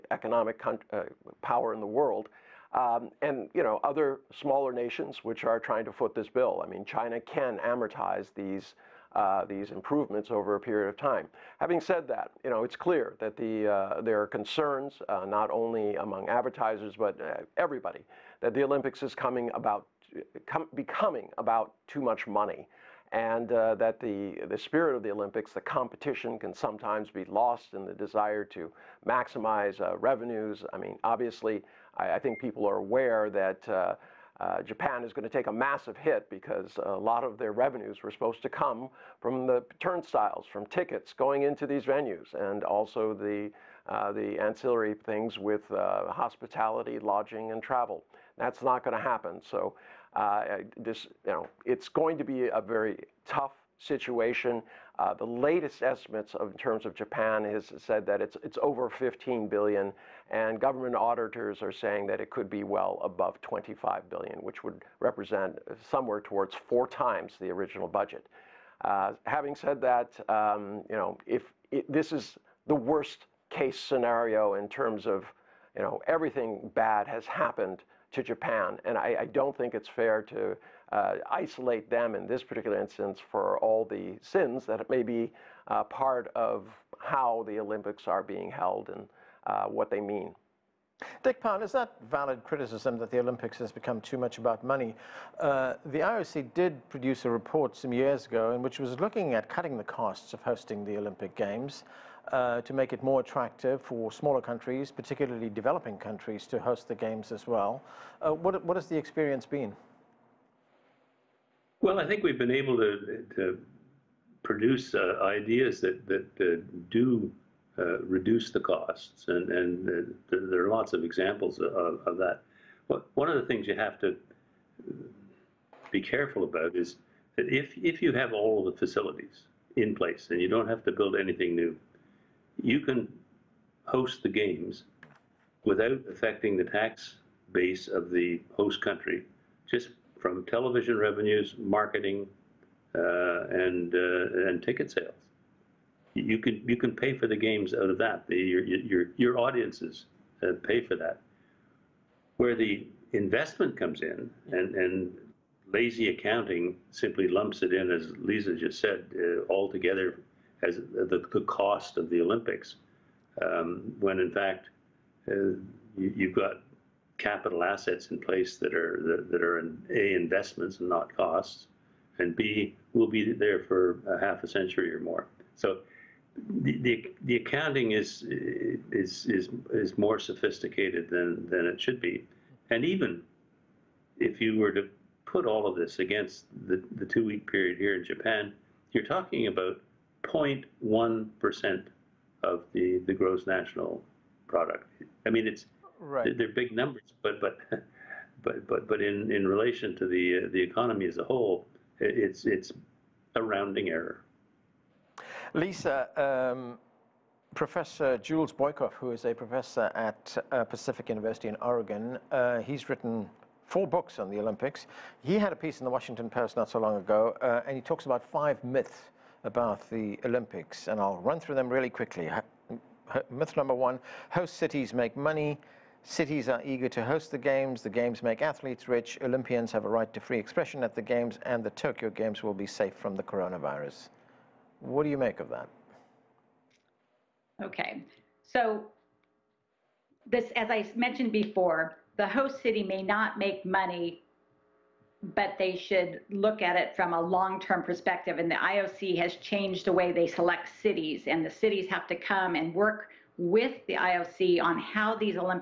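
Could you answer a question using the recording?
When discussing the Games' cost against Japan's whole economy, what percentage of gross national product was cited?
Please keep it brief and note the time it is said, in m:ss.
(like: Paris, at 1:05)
0.1 percent, at 3:10.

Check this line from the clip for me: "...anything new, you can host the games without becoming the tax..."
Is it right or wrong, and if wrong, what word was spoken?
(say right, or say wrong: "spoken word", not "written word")
wrong: "affecting", not "becoming".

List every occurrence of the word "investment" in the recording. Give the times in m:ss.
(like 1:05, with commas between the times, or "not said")
2:33, 2:50.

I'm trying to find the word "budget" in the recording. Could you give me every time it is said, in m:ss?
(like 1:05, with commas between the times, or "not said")
1:07.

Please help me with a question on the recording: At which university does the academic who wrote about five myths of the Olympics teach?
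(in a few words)
Pacific University.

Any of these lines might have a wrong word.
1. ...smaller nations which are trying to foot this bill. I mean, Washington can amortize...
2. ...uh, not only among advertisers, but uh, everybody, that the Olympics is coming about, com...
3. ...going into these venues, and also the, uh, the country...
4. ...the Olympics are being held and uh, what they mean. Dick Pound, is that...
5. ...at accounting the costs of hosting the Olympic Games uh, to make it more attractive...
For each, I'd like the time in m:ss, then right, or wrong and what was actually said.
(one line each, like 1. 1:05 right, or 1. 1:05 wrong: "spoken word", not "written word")
1. 0:04 wrong: "China", not "Washington"
2. 0:15 right
3. 0:41 wrong: "ancillary", not "country"
4. 1:27 right
5. 1:39 wrong: "cutting", not "accounting".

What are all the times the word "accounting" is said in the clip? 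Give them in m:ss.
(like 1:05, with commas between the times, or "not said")
2:36, 2:57.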